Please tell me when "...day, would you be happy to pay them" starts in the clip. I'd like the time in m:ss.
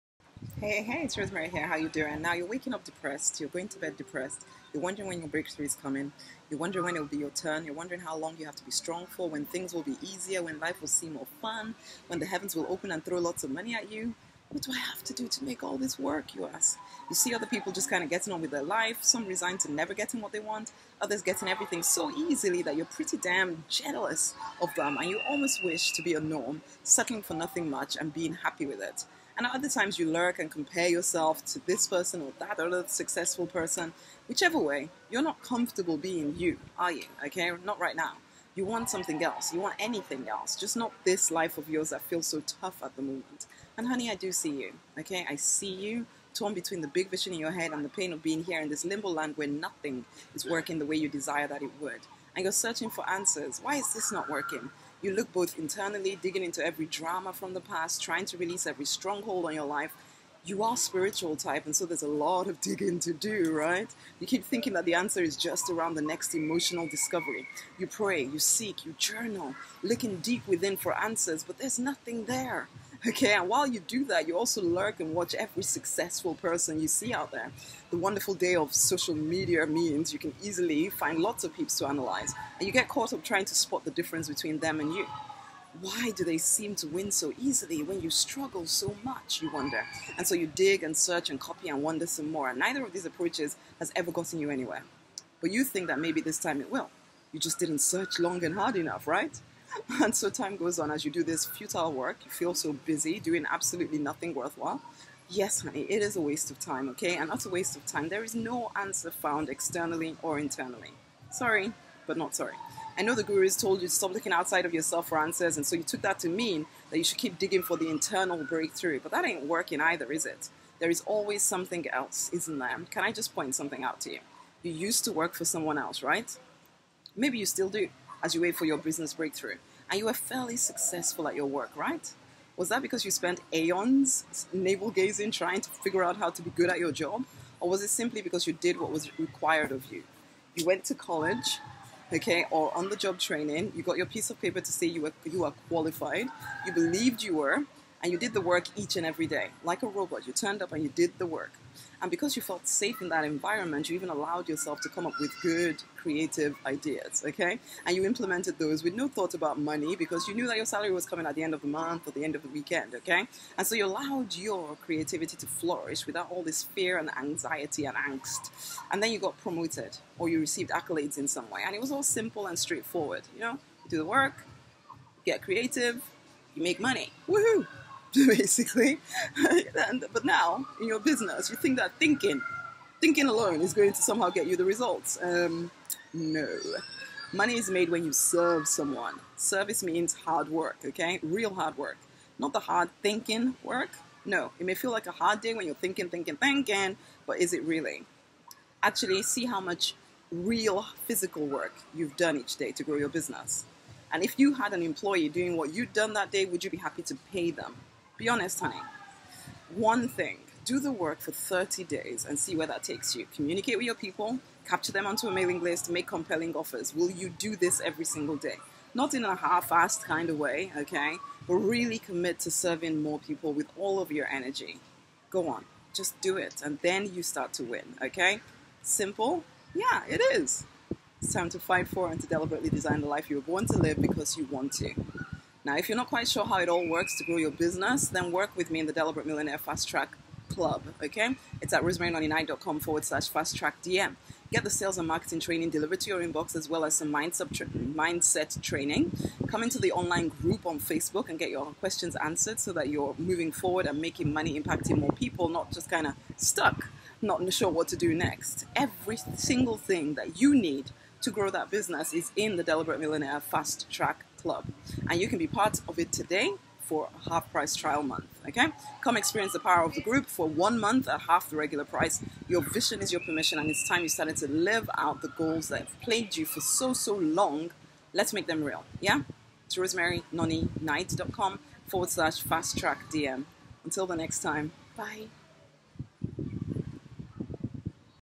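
3:26.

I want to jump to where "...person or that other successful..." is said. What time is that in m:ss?
0:31.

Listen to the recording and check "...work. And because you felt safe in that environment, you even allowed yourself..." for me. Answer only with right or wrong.
right.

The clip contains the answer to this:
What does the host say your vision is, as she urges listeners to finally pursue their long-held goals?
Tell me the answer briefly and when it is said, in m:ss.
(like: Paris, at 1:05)
Your permission, at 4:33.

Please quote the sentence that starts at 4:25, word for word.
And you can be part of it today for a half price trial month.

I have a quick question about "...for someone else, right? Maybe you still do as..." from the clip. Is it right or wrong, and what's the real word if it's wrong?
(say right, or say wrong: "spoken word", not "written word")
right.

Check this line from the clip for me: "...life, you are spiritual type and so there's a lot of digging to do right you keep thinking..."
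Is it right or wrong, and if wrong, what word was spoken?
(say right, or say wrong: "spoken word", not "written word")
right.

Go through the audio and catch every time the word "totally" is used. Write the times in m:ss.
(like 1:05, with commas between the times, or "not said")
not said.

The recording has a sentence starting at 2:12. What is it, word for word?
Was that because you spent aeons navel gazing trying to figure out how to be good at your job?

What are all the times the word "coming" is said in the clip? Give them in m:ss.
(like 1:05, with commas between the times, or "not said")
0:05, 2:41.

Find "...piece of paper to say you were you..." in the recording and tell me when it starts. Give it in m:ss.
2:24.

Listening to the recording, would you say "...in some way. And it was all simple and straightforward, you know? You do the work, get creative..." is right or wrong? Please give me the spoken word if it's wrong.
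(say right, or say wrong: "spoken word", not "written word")
right.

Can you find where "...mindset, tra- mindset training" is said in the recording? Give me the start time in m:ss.
4:07.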